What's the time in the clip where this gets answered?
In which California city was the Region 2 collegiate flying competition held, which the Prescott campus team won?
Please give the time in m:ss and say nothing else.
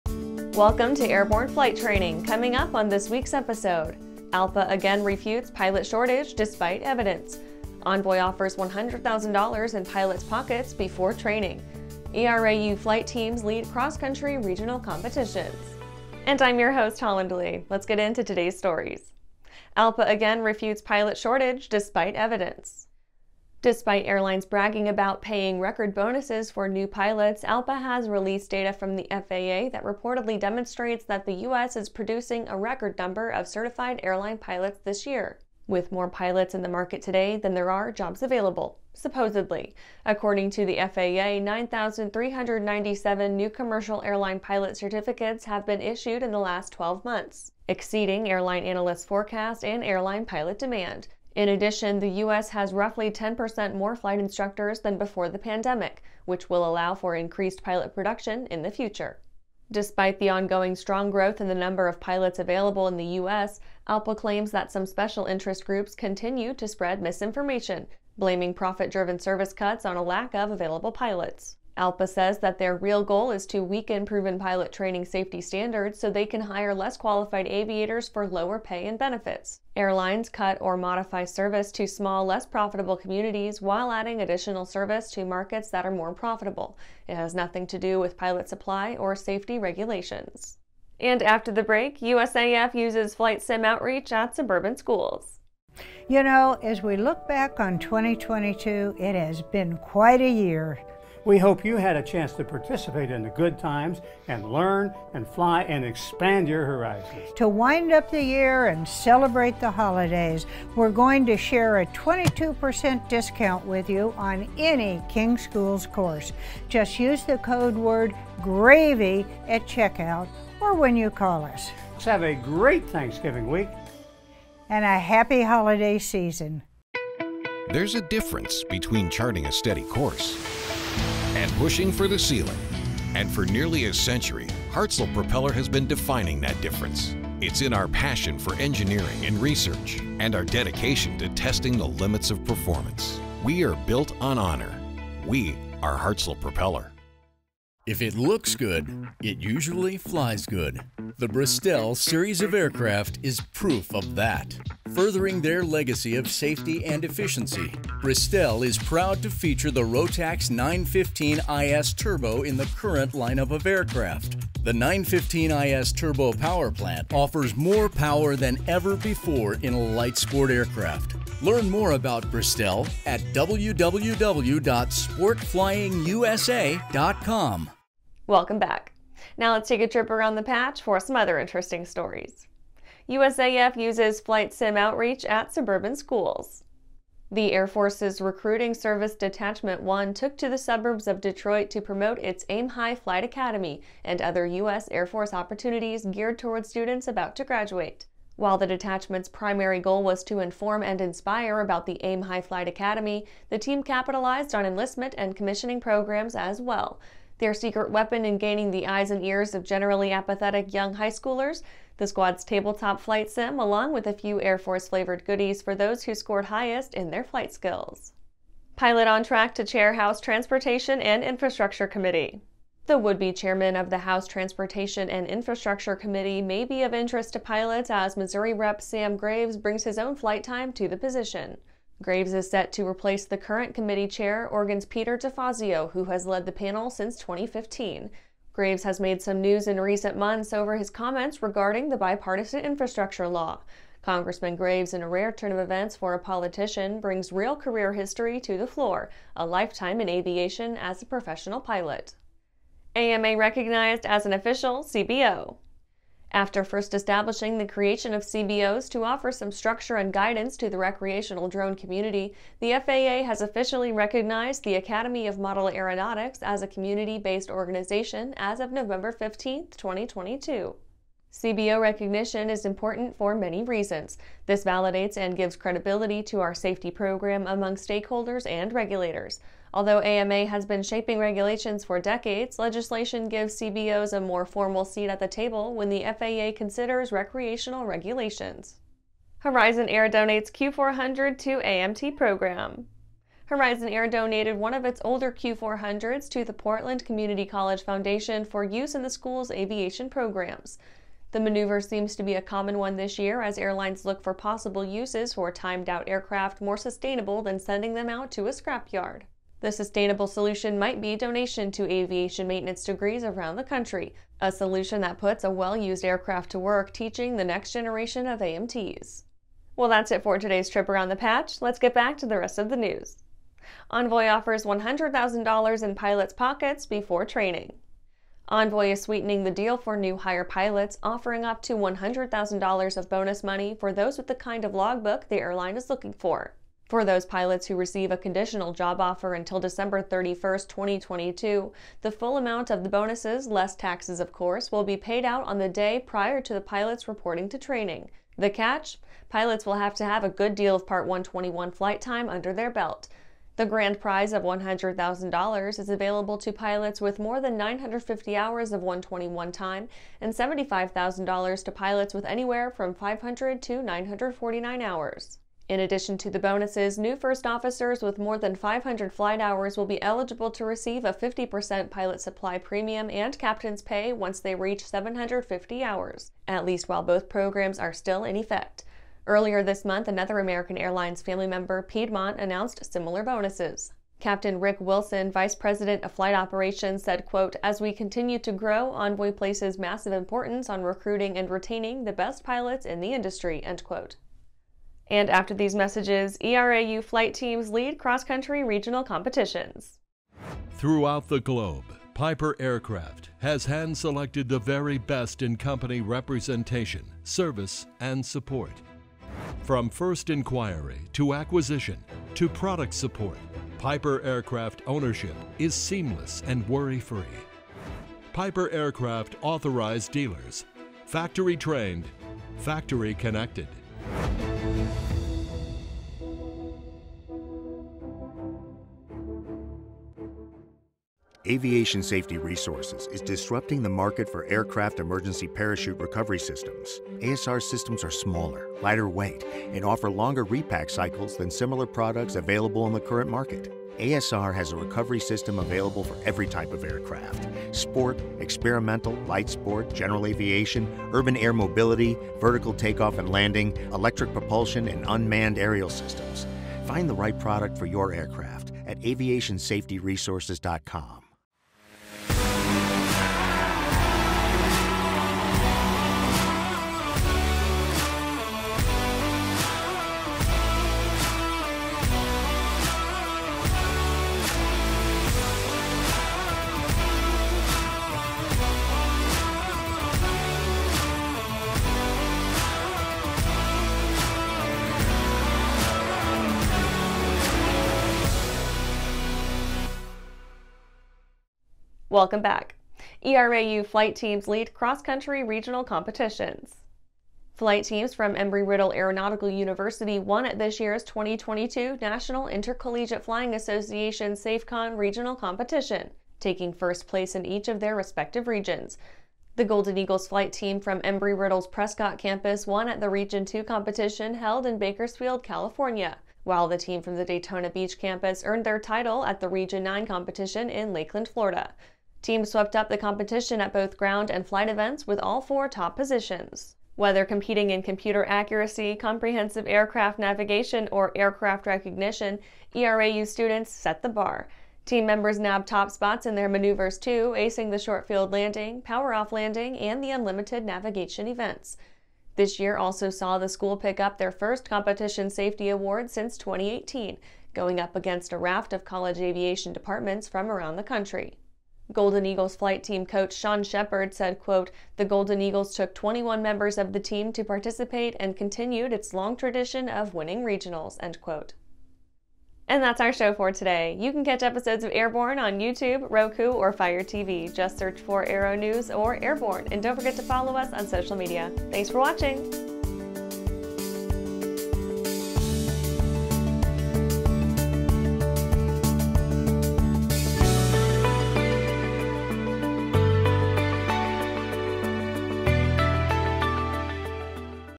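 8:34.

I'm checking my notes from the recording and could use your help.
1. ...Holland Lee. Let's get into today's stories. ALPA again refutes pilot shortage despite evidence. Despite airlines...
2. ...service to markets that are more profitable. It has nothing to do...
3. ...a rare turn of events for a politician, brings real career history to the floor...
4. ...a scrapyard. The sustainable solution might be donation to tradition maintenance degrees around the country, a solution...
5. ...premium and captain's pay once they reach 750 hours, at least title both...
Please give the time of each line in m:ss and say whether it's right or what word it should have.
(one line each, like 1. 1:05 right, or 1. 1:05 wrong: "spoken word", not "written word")
1. 0:16 right
2. 1:24 right
3. 4:05 right
4. 5:08 wrong: "aviation", not "tradition"
5. 6:12 wrong: "while", not "title".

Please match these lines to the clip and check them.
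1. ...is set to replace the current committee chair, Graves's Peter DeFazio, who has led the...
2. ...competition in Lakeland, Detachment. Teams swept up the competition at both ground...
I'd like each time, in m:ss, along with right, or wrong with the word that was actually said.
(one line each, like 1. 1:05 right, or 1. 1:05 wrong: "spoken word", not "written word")
1. 3:52 wrong: "Oregon", not "Graves"
2. 8:40 wrong: "Florida", not "Detachment".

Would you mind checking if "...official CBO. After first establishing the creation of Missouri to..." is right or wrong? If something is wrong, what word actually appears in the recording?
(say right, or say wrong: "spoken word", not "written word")
wrong: "CBOs", not "Missouri".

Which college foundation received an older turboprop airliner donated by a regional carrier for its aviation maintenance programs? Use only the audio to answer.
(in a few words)
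Portland Community College Foundation.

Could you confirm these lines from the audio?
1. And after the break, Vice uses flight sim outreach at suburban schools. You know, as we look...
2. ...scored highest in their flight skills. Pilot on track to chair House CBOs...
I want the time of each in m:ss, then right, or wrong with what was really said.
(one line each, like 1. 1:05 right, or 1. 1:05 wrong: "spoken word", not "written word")
1. 1:30 wrong: "USAF", not "Vice"
2. 3:36 wrong: "Transportation", not "CBOs".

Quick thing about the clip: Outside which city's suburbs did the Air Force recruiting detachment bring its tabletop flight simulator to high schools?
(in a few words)
Detroit.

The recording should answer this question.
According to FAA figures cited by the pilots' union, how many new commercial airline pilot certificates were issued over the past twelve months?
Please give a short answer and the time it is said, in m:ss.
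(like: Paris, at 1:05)
9,397, at 0:41.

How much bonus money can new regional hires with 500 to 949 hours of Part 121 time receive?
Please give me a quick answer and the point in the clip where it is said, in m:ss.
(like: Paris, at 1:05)
$75,000, at 6:00.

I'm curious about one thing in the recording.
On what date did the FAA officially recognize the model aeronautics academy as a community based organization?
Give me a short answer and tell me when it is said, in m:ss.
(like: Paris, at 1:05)
November 15, 2022, at 4:28.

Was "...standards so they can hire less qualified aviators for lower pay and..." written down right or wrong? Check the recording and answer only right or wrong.
right.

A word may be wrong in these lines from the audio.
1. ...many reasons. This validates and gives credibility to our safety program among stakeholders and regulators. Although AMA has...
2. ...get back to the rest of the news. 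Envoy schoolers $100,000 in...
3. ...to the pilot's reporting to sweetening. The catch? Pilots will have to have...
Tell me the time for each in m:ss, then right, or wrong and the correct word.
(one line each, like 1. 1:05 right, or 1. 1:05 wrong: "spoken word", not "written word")
1. 4:33 right
2. 5:21 wrong: "offers", not "schoolers"
3. 5:46 wrong: "training", not "sweetening".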